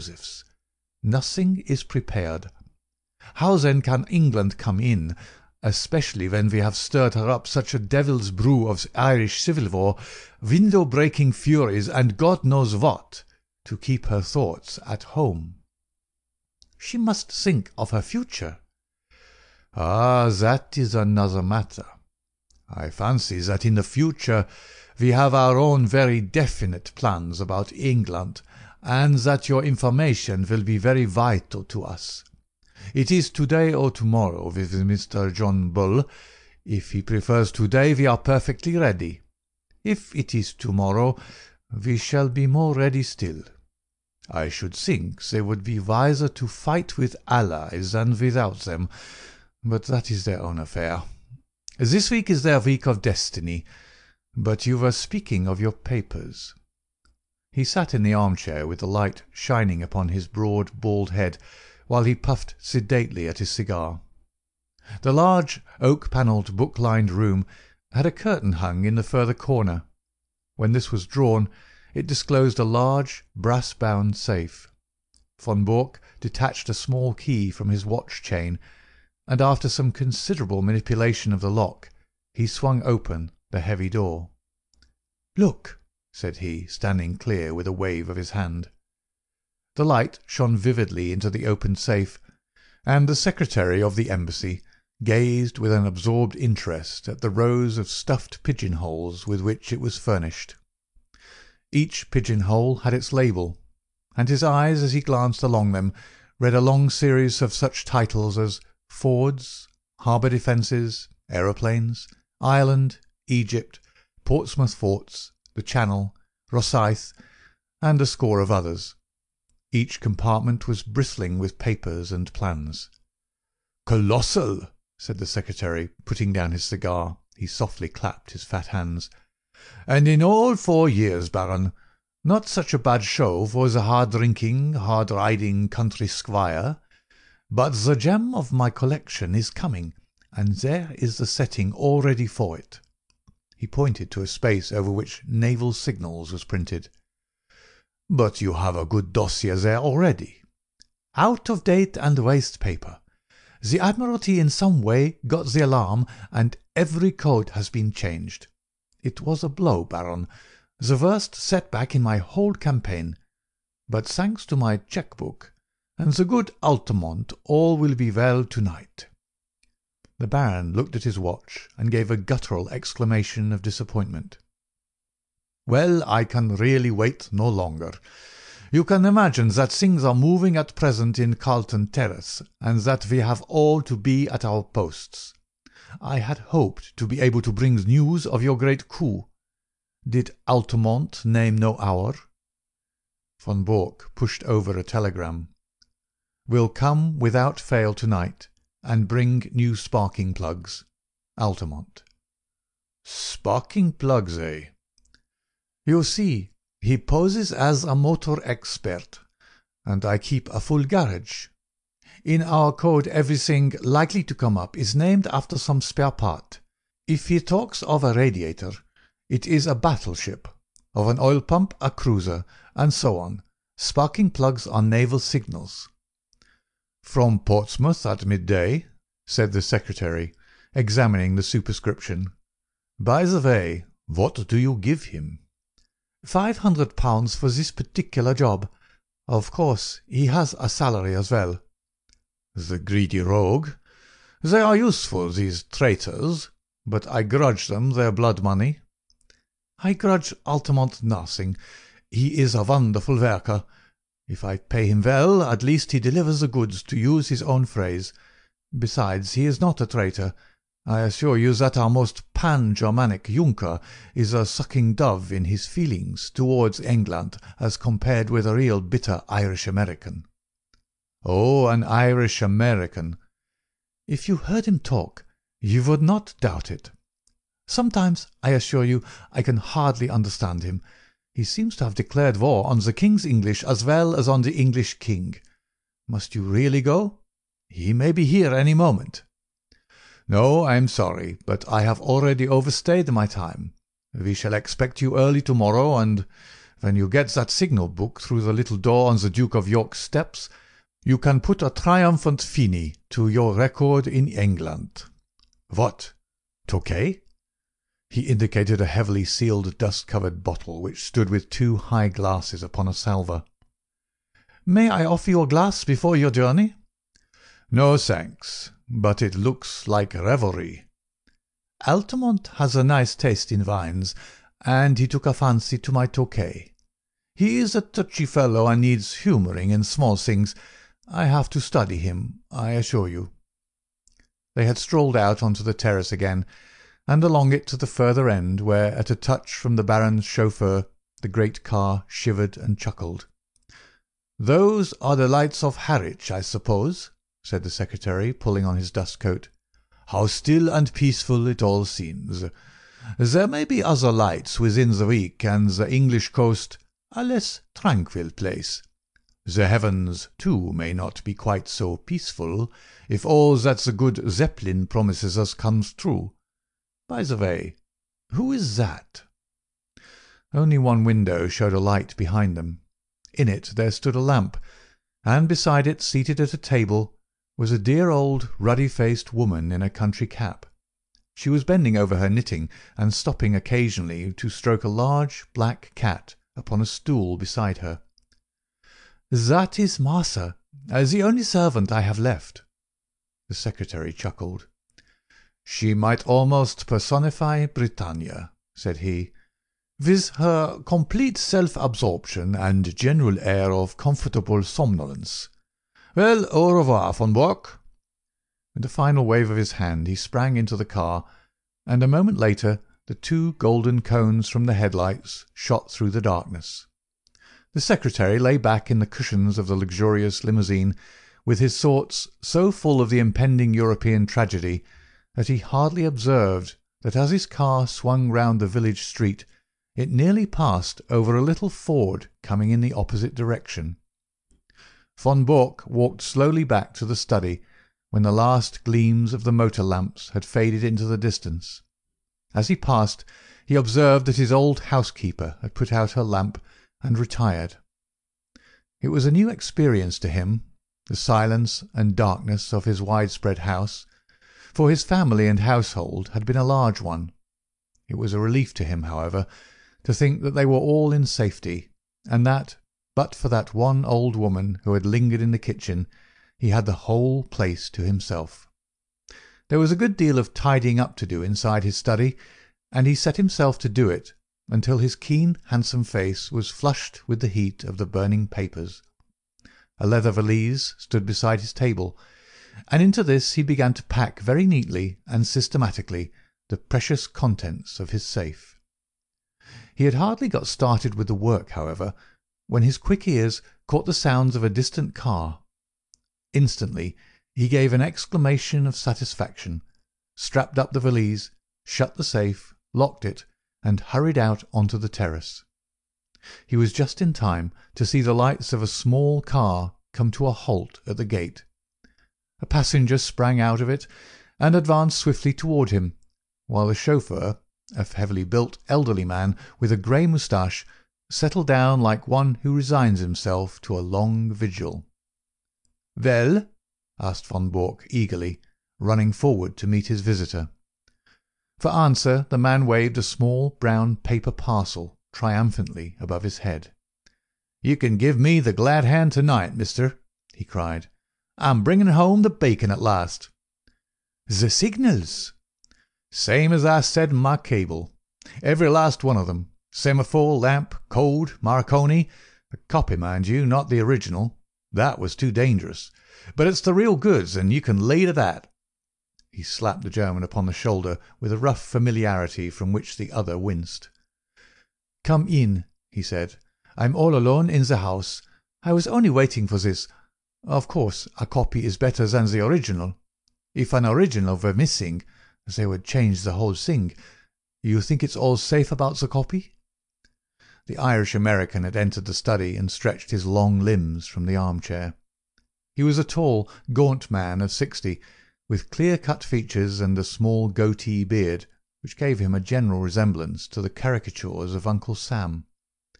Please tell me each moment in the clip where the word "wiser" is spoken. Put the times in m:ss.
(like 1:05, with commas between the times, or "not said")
0:45.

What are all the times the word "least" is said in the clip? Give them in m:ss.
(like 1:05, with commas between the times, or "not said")
4:15.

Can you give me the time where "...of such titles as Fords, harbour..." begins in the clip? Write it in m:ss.
1:47.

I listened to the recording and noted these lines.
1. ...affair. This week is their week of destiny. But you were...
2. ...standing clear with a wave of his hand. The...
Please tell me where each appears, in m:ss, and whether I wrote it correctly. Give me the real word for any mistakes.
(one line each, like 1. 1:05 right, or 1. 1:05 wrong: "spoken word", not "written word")
1. 0:50 right
2. 1:26 right.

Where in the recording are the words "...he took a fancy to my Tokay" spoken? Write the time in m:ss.
5:24.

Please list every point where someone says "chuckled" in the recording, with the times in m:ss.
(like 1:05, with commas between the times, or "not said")
5:42, 6:34.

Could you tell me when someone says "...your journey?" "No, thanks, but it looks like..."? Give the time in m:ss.
5:16.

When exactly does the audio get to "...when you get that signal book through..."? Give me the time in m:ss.
4:56.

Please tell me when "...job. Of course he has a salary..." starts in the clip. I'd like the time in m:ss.
3:58.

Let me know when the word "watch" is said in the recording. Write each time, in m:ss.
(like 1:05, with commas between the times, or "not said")
1:17, 2:51.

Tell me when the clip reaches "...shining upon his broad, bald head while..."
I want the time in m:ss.
0:59.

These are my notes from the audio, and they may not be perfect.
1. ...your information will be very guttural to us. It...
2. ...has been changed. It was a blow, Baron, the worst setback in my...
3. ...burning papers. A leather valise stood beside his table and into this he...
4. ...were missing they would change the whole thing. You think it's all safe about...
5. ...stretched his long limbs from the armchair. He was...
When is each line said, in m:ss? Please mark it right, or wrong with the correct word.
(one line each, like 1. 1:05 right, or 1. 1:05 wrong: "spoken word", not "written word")
1. 0:29 wrong: "vital", not "guttural"
2. 2:37 right
3. 7:58 right
4. 9:34 right
5. 9:42 right.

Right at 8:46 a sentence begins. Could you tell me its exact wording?
"Well?" asked von Bork eagerly, running forward to meet his visitor.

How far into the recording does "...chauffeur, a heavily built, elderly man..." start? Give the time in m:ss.
8:36.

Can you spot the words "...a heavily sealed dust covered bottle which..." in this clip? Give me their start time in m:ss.
5:08.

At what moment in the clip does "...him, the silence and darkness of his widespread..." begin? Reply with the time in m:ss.
7:30.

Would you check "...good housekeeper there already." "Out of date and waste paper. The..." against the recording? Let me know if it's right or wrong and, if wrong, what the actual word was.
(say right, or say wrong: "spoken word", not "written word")
wrong: "dossier", not "housekeeper".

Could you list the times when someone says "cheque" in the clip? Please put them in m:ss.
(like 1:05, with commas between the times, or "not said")
2:44.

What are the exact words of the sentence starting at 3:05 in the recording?
I had hoped to be able to bring news of your great coup.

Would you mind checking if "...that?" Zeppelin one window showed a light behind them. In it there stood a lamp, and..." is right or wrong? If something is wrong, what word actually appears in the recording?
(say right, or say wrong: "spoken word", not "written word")
wrong: "Only", not "Zeppelin".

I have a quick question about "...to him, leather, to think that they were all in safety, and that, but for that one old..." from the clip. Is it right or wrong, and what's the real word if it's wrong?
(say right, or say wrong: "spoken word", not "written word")
wrong: "however", not "leather".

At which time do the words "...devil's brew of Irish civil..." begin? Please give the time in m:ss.
0:07.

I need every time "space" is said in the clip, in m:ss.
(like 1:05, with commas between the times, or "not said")
2:24.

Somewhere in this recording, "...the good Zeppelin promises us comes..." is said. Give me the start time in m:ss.
6:03.